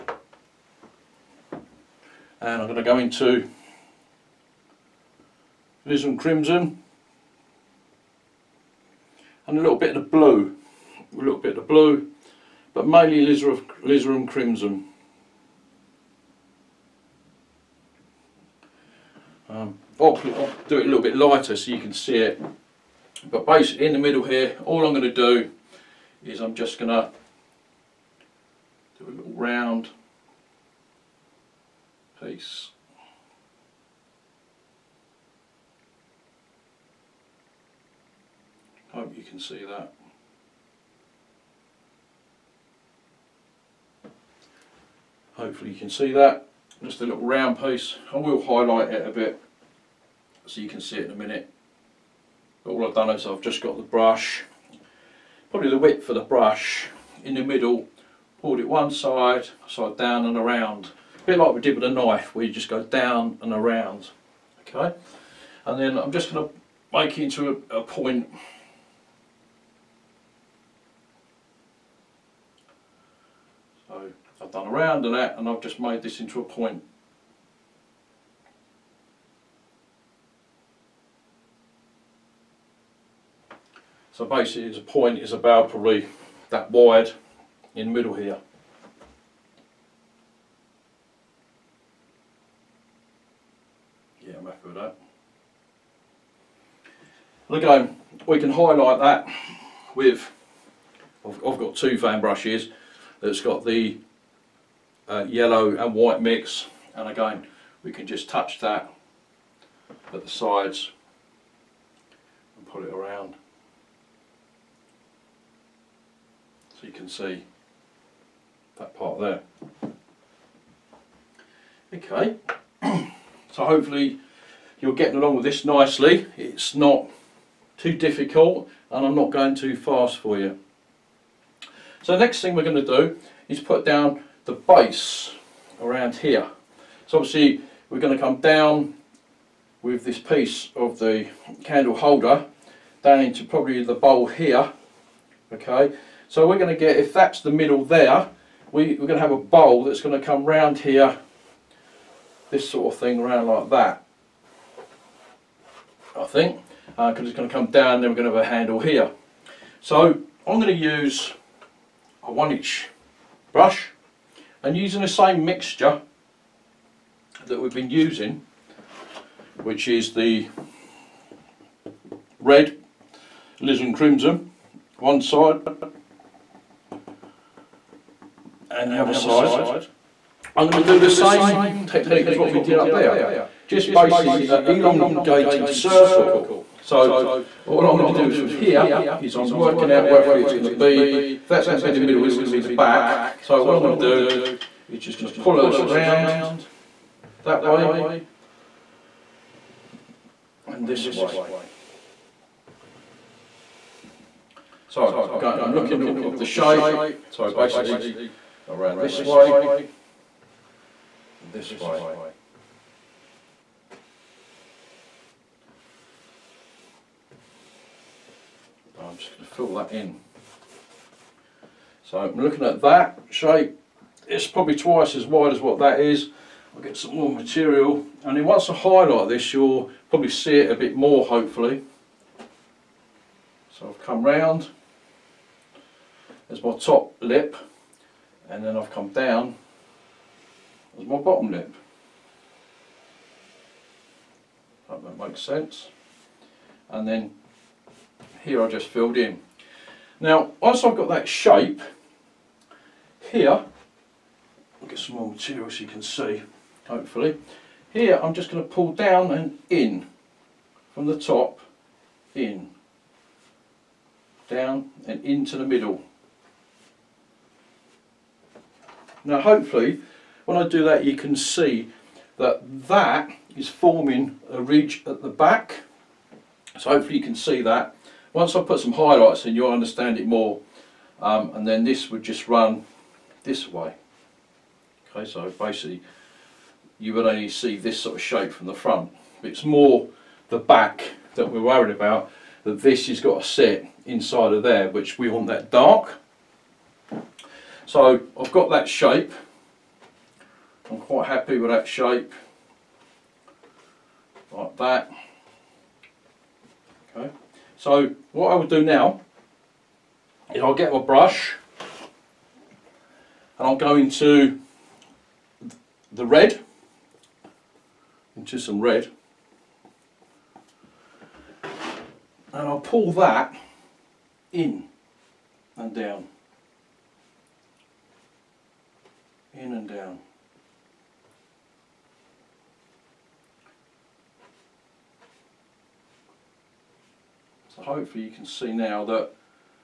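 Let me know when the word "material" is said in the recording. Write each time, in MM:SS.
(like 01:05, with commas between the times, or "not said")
03:47, 04:15.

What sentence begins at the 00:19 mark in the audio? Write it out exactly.
Um, I'll, I'll, do it a little bit lighter so you can see it.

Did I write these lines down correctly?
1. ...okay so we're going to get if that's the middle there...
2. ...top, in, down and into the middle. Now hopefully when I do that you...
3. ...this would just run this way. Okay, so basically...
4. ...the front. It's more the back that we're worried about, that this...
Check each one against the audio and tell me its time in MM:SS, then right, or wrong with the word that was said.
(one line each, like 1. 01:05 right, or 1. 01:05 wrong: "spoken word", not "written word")
1. 02:25 right
2. 04:21 right
3. 04:41 right
4. 04:48 right.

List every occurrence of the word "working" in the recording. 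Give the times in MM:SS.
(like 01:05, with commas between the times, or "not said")
03:09.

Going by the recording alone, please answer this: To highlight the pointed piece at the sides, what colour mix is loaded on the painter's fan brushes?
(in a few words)
yellow and white.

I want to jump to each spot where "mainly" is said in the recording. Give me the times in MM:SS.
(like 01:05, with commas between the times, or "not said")
00:12.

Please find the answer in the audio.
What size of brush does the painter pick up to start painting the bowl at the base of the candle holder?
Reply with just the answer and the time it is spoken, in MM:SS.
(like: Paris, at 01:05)
one inch, at 02:42.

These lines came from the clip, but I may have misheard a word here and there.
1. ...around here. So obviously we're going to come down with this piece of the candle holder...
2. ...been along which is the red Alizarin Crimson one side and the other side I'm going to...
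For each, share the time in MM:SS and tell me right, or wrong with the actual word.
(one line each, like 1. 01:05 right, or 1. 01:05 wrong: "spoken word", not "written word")
1. 02:15 right
2. 02:47 wrong: "using", not "along".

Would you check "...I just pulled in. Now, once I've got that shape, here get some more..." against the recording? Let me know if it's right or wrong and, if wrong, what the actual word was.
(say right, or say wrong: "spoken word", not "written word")
wrong: "filled", not "pulled".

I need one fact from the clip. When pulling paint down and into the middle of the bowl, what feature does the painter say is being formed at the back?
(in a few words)
a ridge.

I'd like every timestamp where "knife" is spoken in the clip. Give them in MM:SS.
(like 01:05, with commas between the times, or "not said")
01:01.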